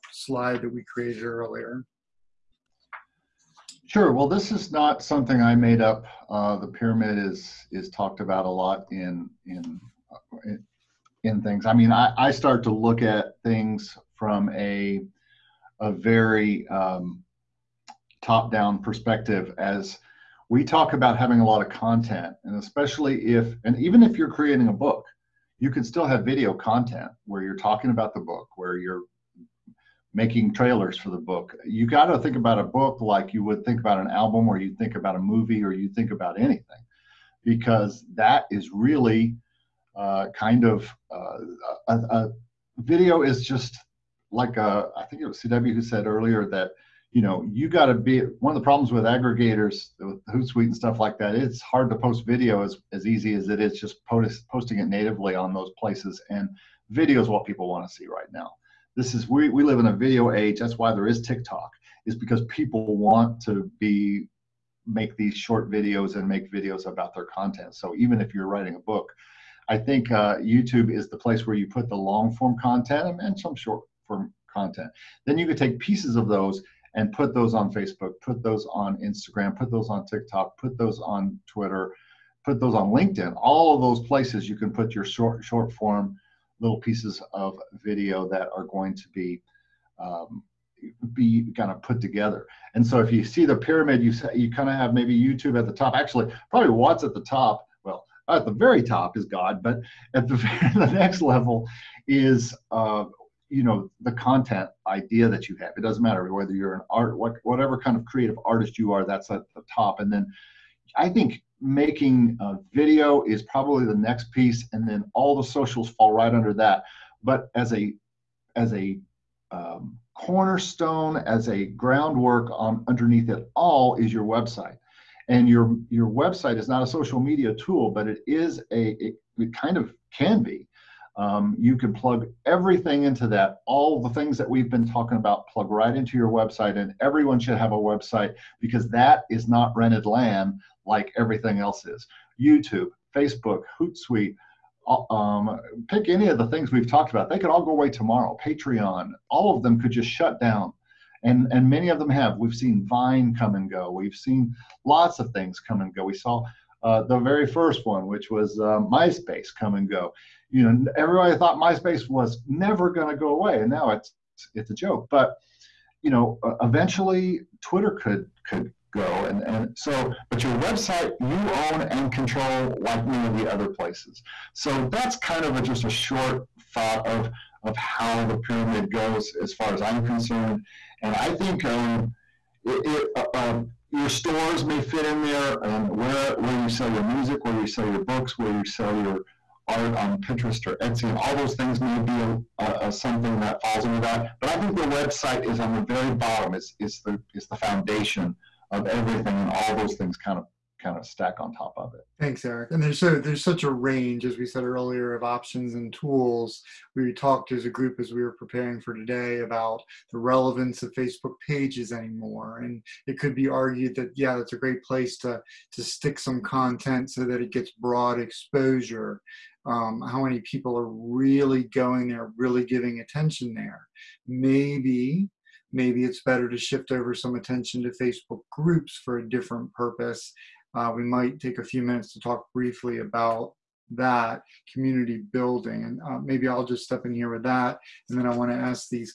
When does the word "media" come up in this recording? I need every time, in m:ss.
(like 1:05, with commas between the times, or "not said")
2:07.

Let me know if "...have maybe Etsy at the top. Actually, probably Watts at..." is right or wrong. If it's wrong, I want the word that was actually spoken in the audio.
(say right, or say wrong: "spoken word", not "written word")
wrong: "YouTube", not "Etsy".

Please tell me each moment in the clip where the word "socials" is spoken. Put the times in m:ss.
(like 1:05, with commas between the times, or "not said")
1:55, 2:06.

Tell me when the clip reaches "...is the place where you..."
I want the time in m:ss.
1:10.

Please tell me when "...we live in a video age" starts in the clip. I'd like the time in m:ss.
0:59.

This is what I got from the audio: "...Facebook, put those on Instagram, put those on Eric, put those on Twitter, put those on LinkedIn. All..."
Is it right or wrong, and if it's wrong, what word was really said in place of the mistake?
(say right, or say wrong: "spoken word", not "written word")
wrong: "TikTok", not "Eric".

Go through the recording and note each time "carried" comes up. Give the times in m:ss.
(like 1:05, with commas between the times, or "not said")
not said.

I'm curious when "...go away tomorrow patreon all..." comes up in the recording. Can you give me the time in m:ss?
2:27.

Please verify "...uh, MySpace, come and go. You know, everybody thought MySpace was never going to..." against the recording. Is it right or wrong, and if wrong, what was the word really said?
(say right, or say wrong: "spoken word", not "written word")
right.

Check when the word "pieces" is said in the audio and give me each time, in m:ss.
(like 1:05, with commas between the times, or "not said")
1:15, 1:26, 1:54.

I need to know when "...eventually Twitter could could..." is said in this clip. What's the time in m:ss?
2:46.